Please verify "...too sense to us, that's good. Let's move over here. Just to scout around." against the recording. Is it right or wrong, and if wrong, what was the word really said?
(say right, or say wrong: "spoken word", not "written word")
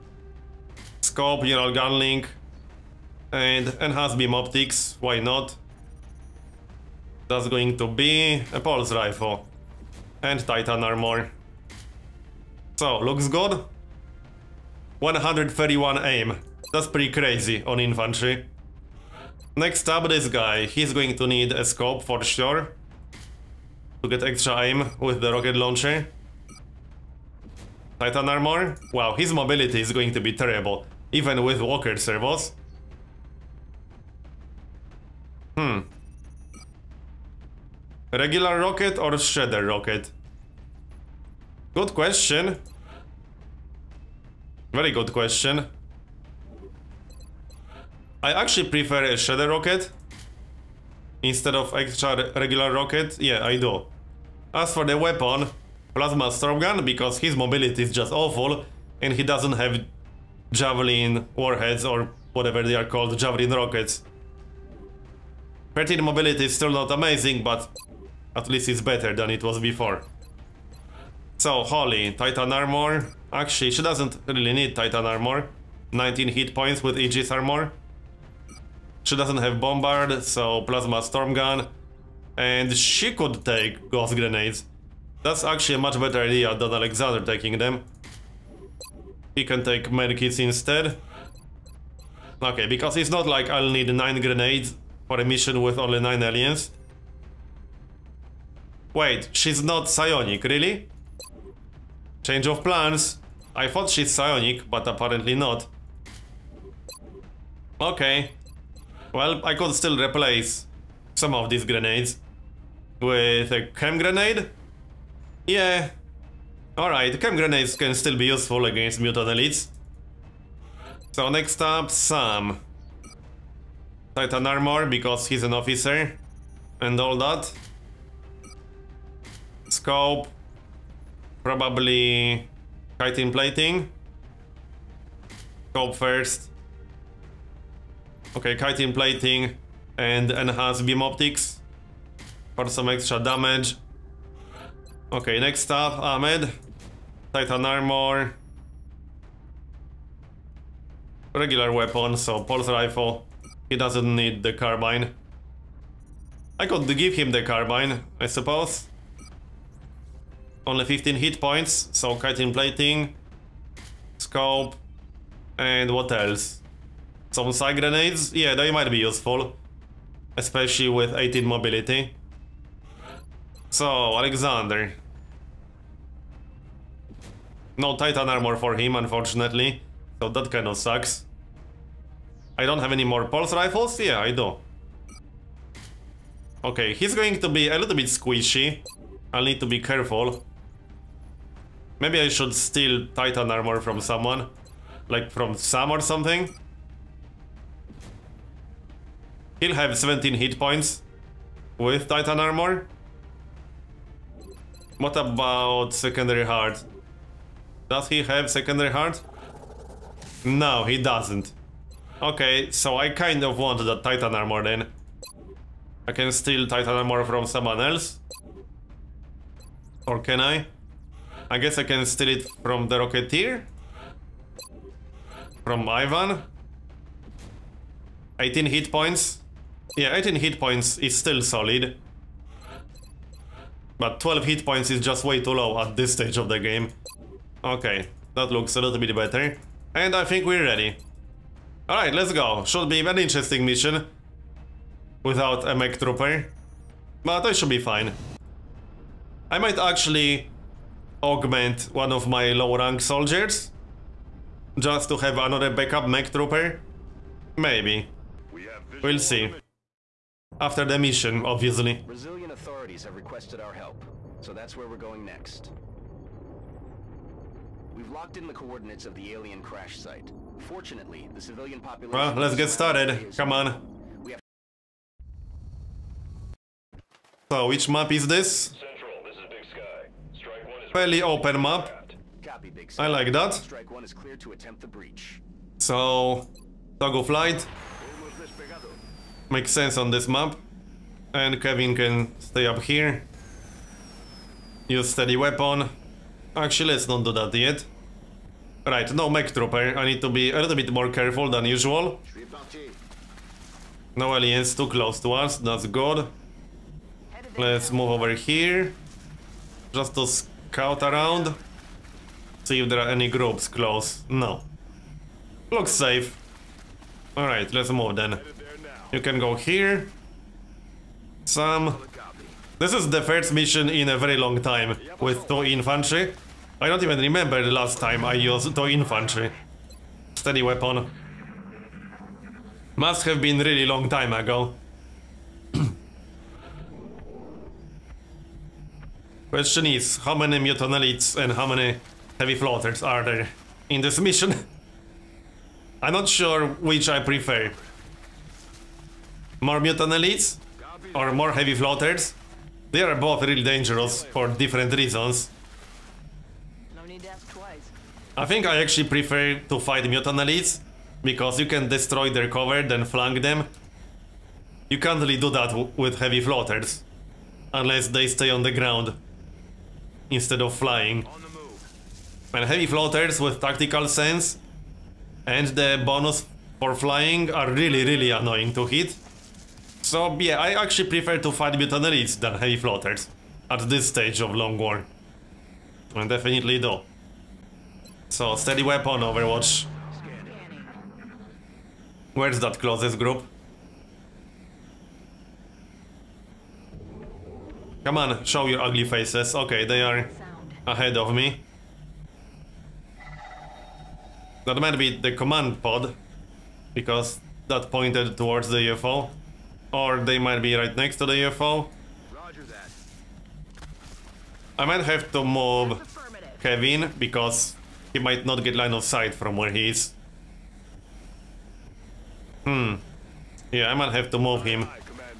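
wrong: "close", not "sense".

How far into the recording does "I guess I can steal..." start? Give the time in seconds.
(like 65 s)
221 s.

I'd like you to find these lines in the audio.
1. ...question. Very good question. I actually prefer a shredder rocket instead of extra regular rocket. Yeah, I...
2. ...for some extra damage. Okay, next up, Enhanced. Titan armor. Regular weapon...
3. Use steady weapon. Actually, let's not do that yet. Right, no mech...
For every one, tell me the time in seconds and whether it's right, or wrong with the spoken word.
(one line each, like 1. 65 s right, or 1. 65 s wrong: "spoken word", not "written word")
1. 41 s right
2. 142 s wrong: "Ahmed", not "Enhanced"
3. 294 s right.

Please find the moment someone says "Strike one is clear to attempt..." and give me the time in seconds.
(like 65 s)
283 s.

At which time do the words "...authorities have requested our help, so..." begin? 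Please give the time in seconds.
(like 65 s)
262 s.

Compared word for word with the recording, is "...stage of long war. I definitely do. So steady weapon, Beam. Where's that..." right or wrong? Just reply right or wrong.
wrong.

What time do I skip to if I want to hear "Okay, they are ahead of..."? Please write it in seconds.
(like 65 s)
399 s.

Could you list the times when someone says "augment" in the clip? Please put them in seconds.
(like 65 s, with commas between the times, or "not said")
251 s.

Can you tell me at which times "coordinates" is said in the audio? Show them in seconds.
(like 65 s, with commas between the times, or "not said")
268 s.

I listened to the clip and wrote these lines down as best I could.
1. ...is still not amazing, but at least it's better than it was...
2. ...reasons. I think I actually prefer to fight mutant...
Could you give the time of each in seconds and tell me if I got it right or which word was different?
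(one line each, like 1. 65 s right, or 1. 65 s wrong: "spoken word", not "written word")
1. 66 s right
2. 354 s right.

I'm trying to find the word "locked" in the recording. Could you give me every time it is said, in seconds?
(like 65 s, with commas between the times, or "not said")
268 s.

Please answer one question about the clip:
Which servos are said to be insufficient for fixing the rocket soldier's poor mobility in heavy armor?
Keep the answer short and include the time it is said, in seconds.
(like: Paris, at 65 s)
Walker servos, at 31 s.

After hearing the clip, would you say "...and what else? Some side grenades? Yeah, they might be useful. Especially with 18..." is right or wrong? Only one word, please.
right.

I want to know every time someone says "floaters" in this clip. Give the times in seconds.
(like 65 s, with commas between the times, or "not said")
342 s, 351 s, 366 s, 372 s, 382 s.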